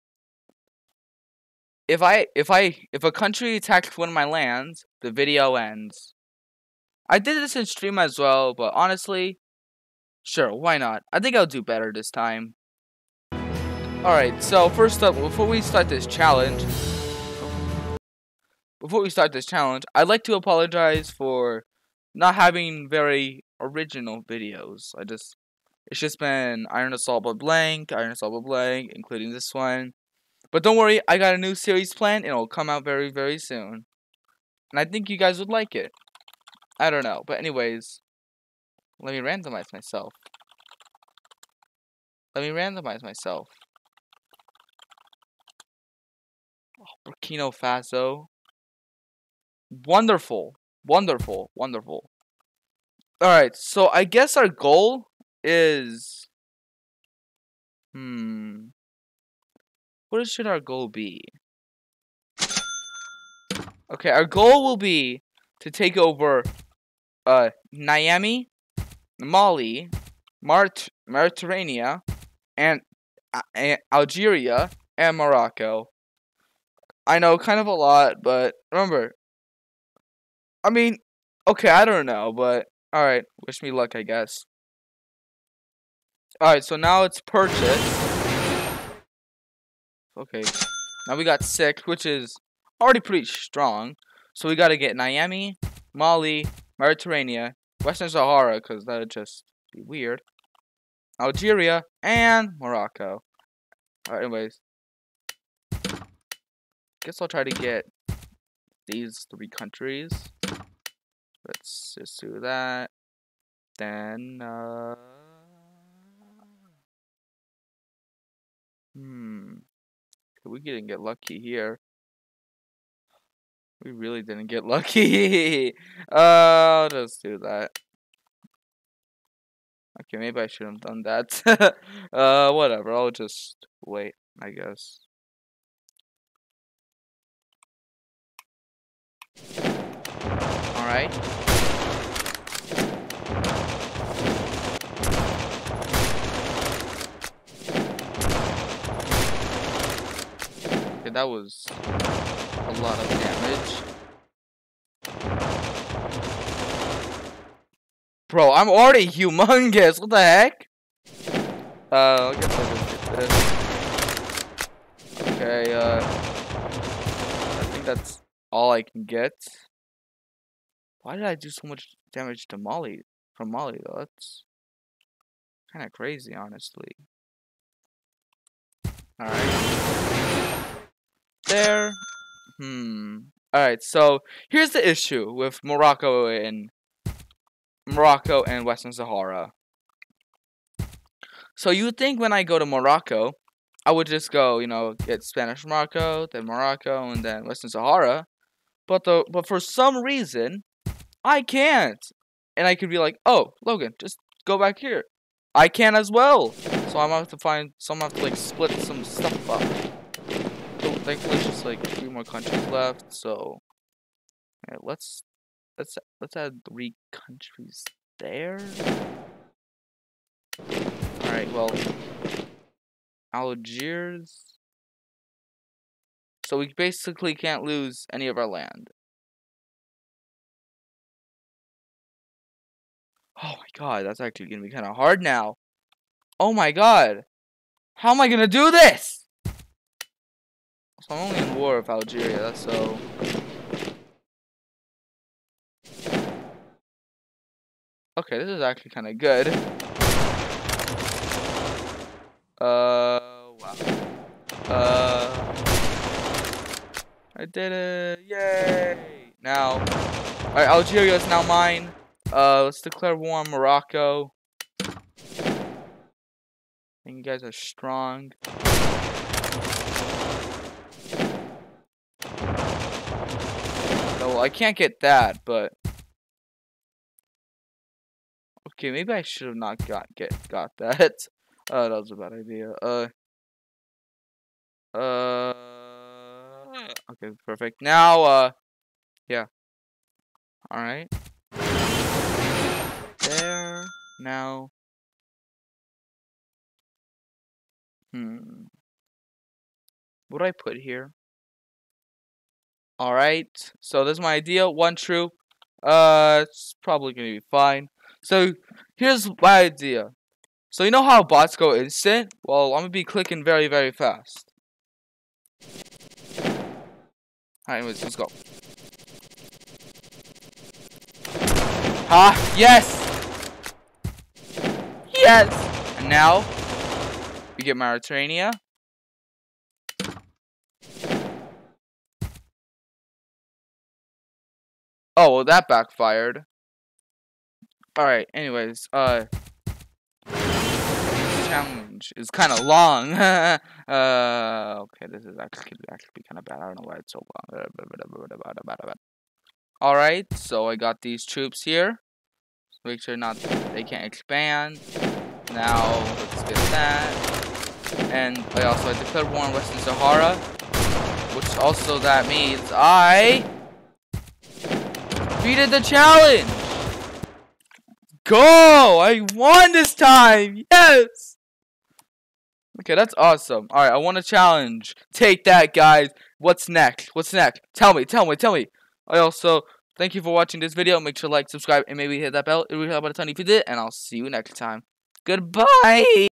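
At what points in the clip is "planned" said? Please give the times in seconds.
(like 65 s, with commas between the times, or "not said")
31 s.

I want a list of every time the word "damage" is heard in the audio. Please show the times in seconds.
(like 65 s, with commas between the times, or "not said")
153 s, 172 s.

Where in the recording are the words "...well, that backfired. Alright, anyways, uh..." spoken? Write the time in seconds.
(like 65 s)
335 s.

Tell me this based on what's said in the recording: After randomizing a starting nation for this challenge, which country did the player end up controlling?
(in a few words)
Burkina Faso.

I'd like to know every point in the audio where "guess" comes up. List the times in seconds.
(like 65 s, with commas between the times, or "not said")
54 s, 84 s, 107 s, 134 s, 162 s.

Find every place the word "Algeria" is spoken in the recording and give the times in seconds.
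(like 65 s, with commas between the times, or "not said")
73 s, 101 s, 241 s, 260 s.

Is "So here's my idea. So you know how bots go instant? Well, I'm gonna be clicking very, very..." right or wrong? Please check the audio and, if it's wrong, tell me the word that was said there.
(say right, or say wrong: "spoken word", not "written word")
right.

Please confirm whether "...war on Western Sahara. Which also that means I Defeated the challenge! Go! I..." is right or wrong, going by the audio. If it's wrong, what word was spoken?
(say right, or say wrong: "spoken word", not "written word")
right.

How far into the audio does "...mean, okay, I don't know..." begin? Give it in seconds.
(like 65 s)
80 s.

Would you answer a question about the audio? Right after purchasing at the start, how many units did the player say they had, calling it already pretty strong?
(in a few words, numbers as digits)
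6.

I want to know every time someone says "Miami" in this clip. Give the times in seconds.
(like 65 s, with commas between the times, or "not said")
67 s, 94 s.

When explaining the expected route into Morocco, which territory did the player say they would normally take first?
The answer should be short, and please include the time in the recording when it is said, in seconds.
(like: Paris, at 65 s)
Spanish Morocco, at 195 s.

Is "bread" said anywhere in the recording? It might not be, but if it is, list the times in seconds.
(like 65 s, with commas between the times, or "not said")
not said.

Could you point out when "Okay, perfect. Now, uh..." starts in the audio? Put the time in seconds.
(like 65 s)
287 s.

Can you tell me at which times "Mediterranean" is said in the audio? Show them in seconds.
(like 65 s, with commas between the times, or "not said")
71 s, 96 s.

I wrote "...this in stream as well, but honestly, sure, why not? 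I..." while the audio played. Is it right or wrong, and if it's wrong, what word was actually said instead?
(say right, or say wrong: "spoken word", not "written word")
right.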